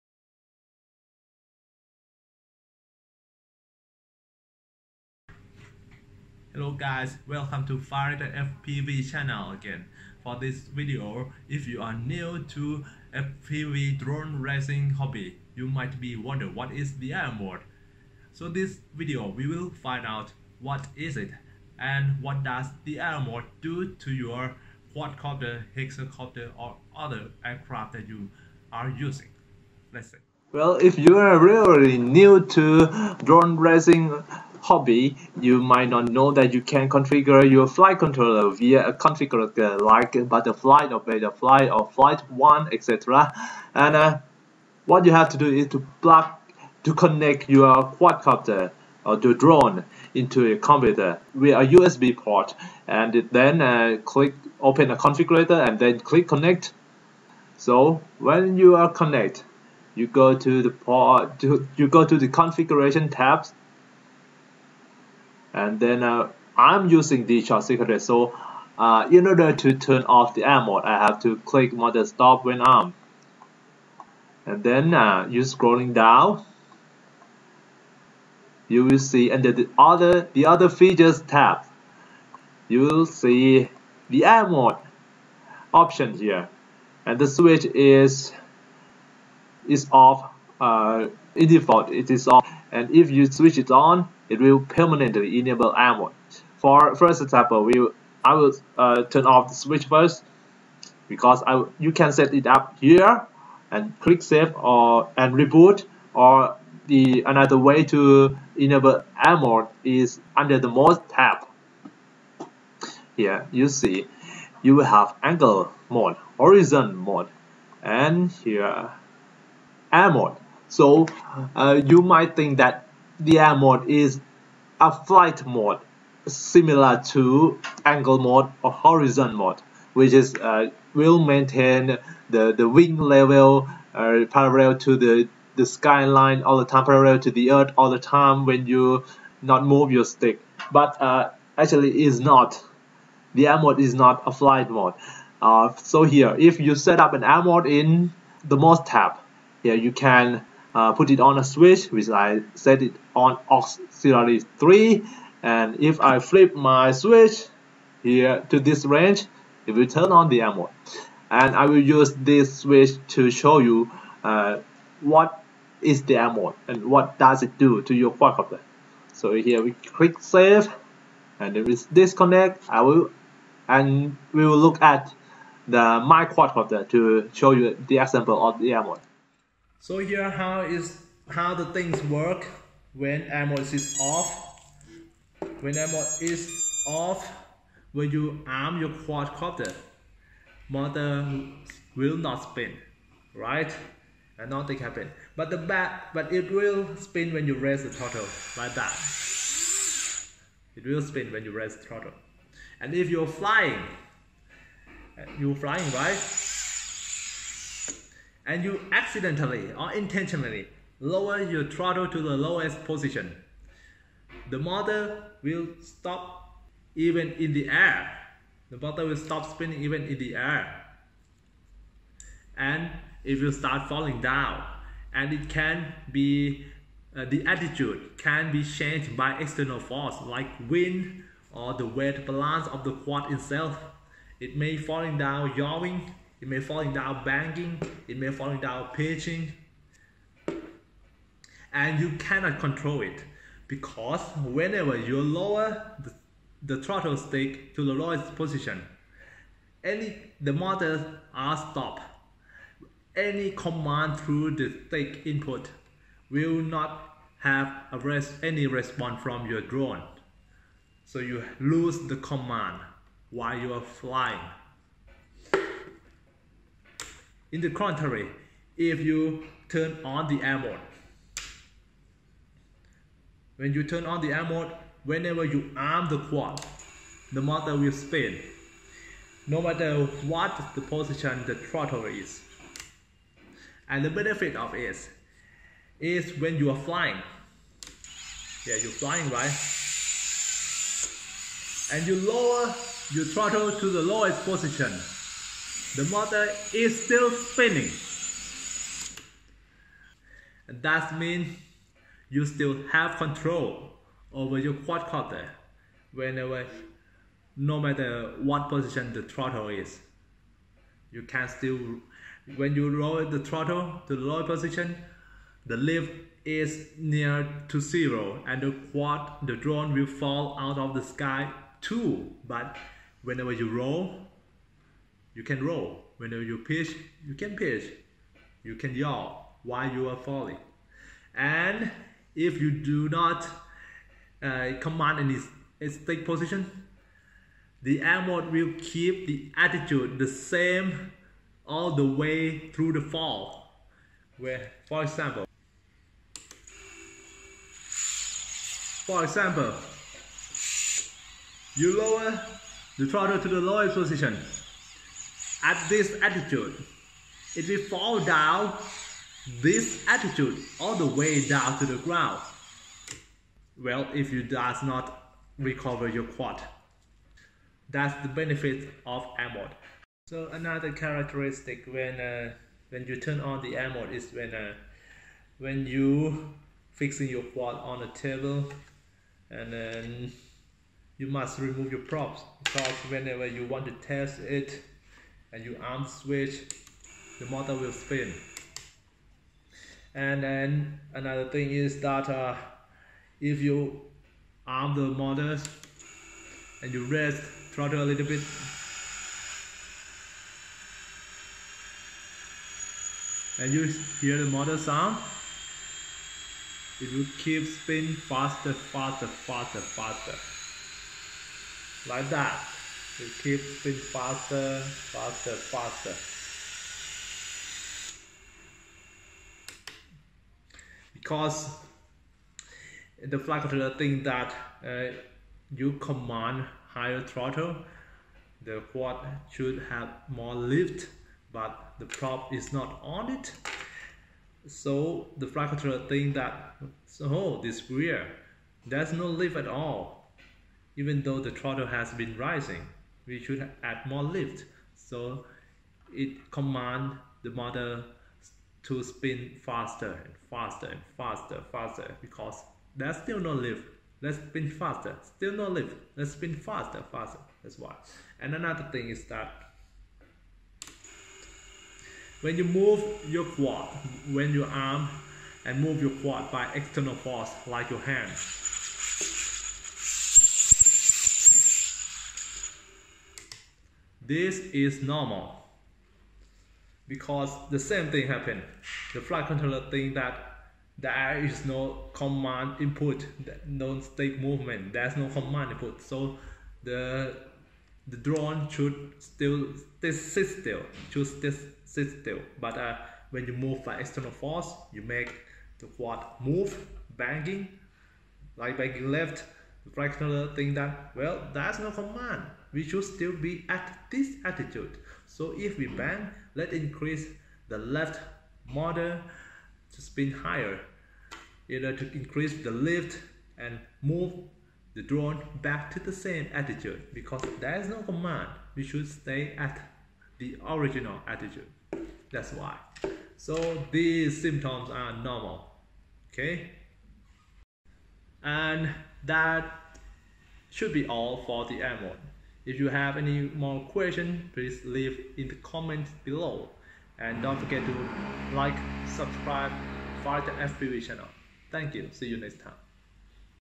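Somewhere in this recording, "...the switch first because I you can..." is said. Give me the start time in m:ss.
1:39.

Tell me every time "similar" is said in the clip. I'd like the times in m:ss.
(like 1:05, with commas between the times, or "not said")
2:06.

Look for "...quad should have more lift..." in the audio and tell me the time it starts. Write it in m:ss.
7:08.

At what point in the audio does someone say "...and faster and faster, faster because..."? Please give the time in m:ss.
7:30.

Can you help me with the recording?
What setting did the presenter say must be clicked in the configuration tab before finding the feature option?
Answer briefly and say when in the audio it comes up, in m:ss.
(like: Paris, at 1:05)
Stop when arm, at 1:12.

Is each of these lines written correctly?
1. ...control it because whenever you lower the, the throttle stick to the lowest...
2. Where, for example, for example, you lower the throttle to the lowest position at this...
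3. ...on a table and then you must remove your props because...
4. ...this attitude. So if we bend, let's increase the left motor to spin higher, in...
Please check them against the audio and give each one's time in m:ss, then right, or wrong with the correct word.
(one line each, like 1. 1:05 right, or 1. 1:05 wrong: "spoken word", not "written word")
1. 4:02 right
2. 5:44 right
3. 6:17 right
4. 8:24 right.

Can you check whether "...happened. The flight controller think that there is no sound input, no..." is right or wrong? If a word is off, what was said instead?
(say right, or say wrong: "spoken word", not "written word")
wrong: "command", not "sound".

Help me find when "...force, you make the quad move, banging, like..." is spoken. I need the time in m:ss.
8:14.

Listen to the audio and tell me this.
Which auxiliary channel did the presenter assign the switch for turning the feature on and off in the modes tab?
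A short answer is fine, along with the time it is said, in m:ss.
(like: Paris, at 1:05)
Auxiliary 3, at 2:33.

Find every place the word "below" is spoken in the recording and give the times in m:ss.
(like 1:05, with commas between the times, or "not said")
8:56.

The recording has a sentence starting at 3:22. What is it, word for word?
And if you're flying, you're flying, right?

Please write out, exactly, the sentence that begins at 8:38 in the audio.
We should stay at the original attitude.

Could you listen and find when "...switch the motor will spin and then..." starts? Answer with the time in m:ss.
6:26.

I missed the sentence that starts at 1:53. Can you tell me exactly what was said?
Here you see you will have angle mode, horizon mode, and here air mode.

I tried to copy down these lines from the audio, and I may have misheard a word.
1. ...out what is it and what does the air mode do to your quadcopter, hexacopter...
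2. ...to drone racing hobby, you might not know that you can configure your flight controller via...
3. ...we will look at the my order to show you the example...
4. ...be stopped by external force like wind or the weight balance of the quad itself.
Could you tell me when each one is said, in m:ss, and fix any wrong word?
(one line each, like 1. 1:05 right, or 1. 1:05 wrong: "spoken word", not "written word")
1. 0:20 right
2. 0:32 right
3. 2:54 wrong: "quadcopter", not "order"
4. 3:48 wrong: "changed", not "stopped".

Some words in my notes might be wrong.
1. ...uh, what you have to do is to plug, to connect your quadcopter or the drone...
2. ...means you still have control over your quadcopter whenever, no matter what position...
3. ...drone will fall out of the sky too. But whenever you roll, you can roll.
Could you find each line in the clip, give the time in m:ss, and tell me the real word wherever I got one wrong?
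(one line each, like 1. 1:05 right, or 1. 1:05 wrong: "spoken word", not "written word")
1. 0:43 right
2. 5:01 right
3. 5:19 right.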